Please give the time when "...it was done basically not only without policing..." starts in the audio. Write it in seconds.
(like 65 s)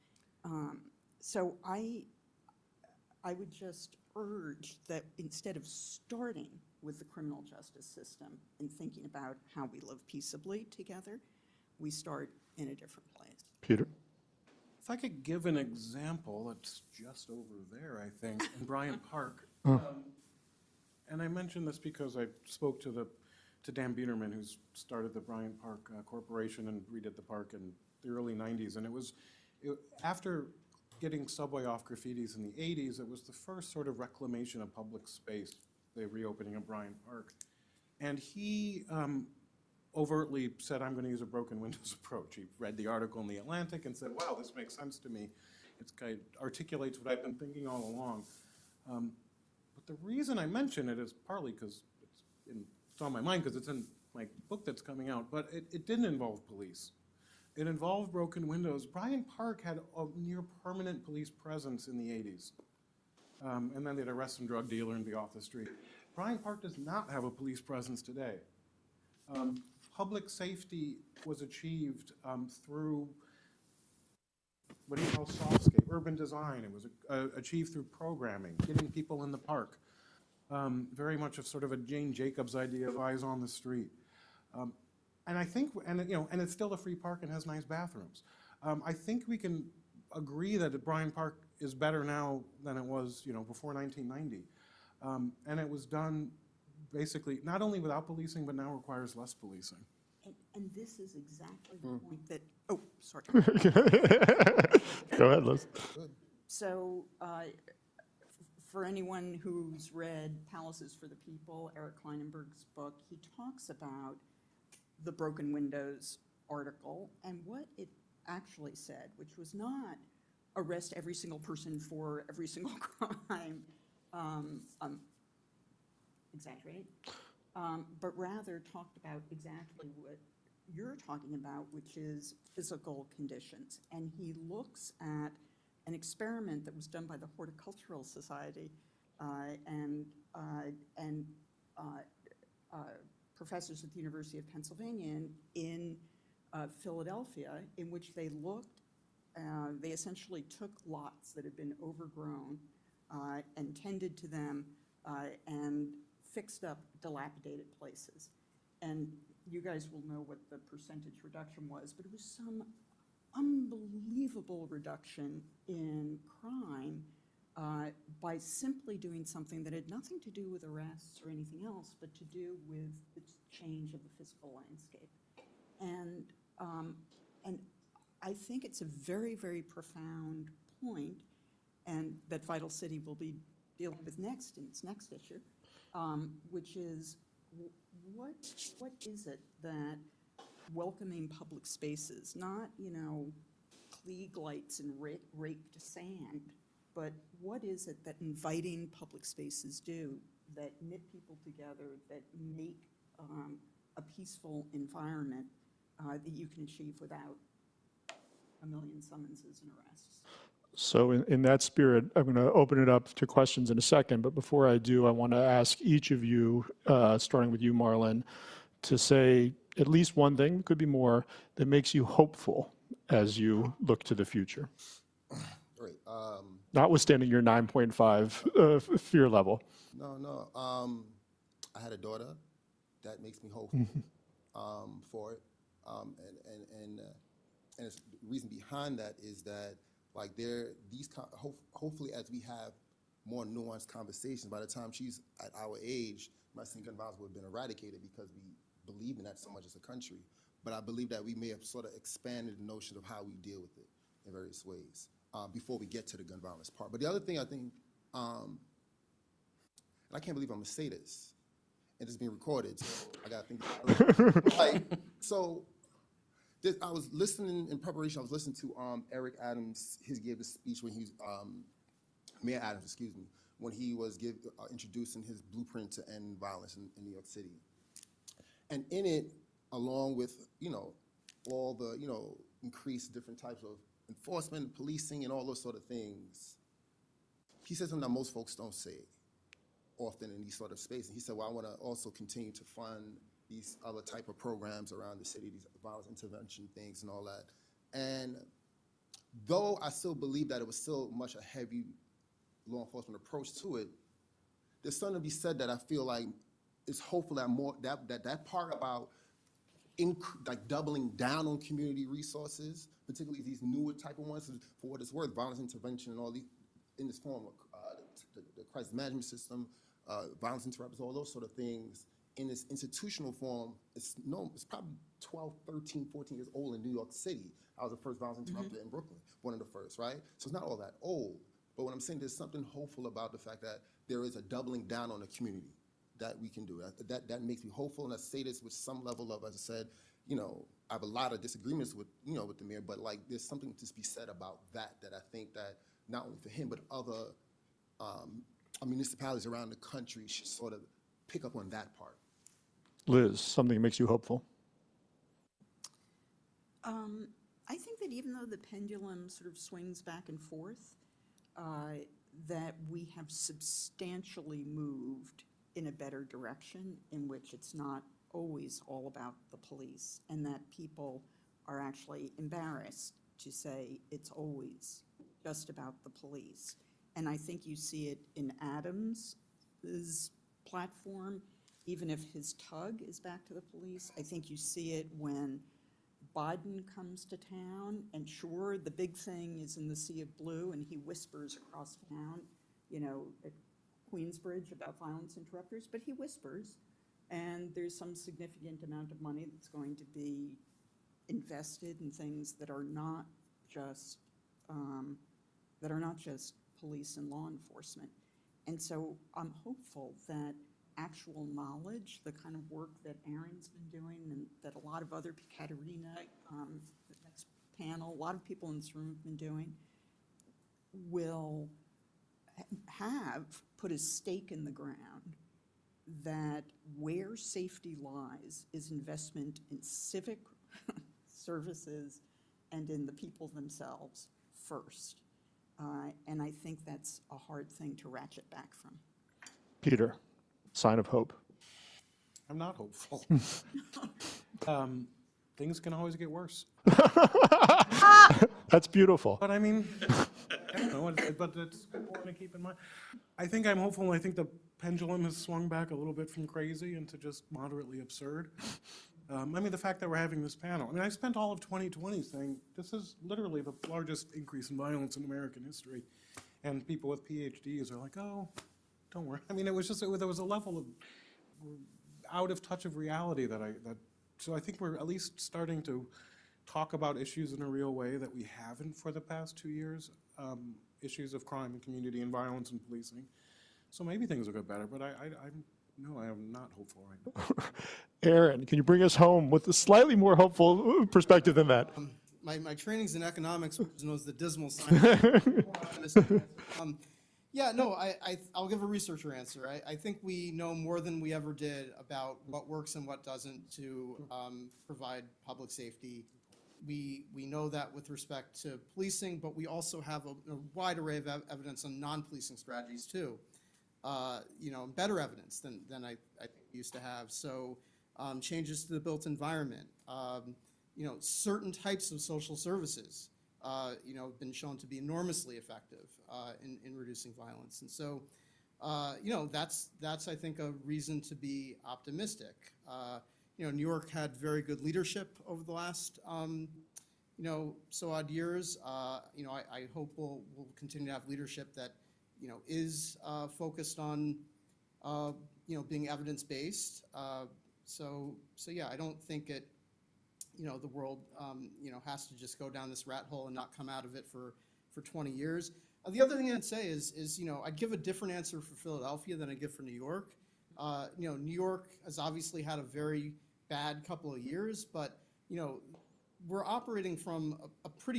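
95 s.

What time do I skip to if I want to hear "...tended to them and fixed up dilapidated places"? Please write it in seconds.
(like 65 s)
153 s.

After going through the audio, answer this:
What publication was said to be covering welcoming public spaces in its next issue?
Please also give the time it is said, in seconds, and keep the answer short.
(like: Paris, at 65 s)
Vital City, at 182 s.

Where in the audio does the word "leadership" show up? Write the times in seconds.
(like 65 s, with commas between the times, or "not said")
534 s, 541 s.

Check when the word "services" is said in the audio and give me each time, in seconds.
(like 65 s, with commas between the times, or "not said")
431 s, 522 s.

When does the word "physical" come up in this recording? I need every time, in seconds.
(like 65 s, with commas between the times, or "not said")
132 s, 174 s.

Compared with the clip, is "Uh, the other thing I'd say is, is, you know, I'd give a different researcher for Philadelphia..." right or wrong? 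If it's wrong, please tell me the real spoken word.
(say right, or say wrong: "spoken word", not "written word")
wrong: "answer", not "researcher".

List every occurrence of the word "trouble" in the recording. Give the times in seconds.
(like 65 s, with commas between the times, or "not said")
not said.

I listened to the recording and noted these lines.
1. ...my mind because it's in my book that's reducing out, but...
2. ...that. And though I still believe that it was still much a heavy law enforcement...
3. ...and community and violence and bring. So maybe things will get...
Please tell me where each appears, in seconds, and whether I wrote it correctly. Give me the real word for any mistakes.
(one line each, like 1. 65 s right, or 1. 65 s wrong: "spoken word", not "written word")
1. 53 s wrong: "coming", not "reducing"
2. 297 s right
3. 481 s wrong: "policing", not "bring".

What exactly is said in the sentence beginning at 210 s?
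So in, in that spirit, I'm going to open it up to questions in a second.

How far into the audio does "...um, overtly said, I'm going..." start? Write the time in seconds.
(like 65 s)
38 s.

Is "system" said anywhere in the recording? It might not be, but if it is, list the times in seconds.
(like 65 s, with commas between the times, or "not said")
7 s, 319 s.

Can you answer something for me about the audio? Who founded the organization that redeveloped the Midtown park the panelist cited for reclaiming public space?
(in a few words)
Dan Biederman.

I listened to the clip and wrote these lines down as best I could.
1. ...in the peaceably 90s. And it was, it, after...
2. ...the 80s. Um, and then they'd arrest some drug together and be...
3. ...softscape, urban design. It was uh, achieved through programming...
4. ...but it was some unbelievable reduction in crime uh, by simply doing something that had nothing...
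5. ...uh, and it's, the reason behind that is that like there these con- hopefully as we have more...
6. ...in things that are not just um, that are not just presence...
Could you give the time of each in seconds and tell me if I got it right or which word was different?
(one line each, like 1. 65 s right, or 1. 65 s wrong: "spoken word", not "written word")
1. 27 s wrong: "early", not "peaceably"
2. 61 s wrong: "dealer", not "together"
3. 75 s right
4. 161 s right
5. 236 s right
6. 401 s wrong: "police", not "presence".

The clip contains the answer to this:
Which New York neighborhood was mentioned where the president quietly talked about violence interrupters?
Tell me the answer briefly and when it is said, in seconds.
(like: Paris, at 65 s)
Queensbridge, at 394 s.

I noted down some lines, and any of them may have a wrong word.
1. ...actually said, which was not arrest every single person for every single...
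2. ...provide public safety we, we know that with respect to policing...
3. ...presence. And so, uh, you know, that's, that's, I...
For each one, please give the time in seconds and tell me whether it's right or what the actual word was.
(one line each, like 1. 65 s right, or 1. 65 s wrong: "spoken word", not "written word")
1. 118 s right
2. 504 s right
3. 527 s wrong: "violence", not "presence".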